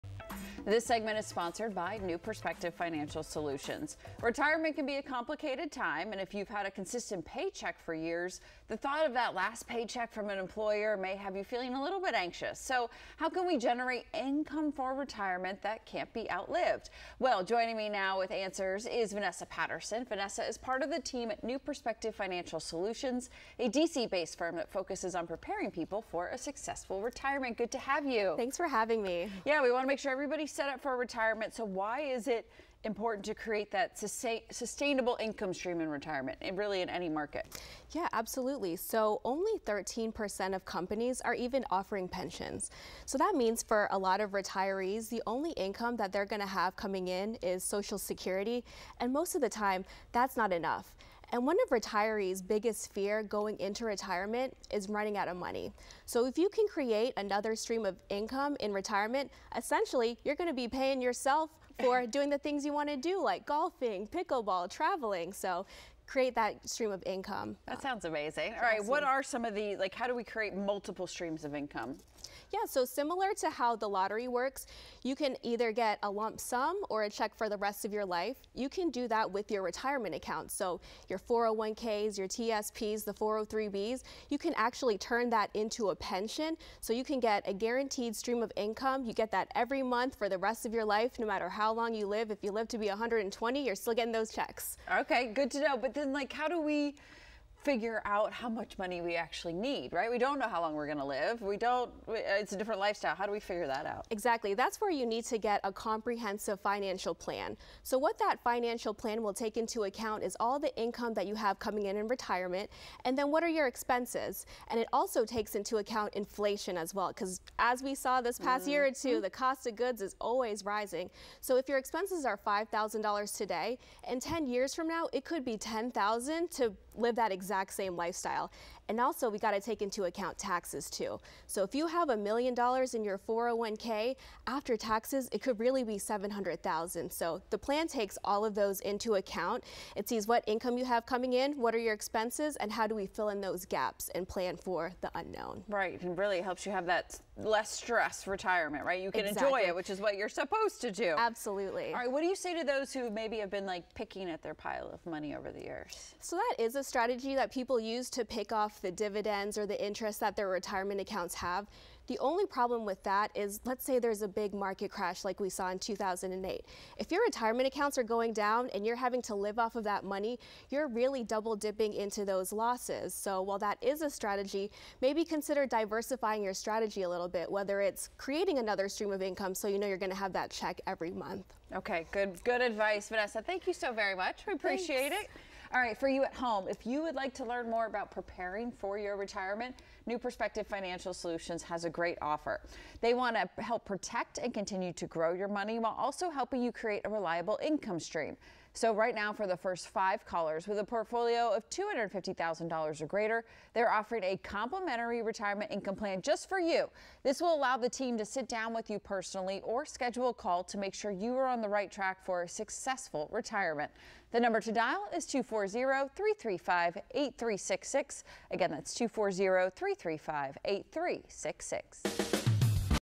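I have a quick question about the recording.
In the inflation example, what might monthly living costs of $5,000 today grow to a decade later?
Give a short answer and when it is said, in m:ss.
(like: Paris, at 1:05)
$10,000, at 2:05.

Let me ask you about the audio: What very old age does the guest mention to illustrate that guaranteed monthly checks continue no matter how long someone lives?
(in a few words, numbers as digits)
120.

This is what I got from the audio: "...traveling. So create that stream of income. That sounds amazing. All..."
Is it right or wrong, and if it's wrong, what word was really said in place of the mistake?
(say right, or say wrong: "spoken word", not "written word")
right.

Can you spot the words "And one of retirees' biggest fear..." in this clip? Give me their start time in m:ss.
0:51.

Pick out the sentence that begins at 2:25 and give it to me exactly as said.
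Right, and really helps you have that less stress retirement, right?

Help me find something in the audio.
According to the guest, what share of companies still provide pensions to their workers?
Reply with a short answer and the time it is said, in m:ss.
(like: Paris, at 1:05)
13%, at 0:39.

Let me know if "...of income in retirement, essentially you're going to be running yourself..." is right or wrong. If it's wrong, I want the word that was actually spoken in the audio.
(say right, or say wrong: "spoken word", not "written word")
wrong: "paying", not "running".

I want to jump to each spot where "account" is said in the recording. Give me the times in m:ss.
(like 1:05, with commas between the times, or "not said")
1:20, 1:49, 1:55, 2:10, 2:19, 2:41, 2:47.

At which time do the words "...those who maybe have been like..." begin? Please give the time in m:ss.
2:32.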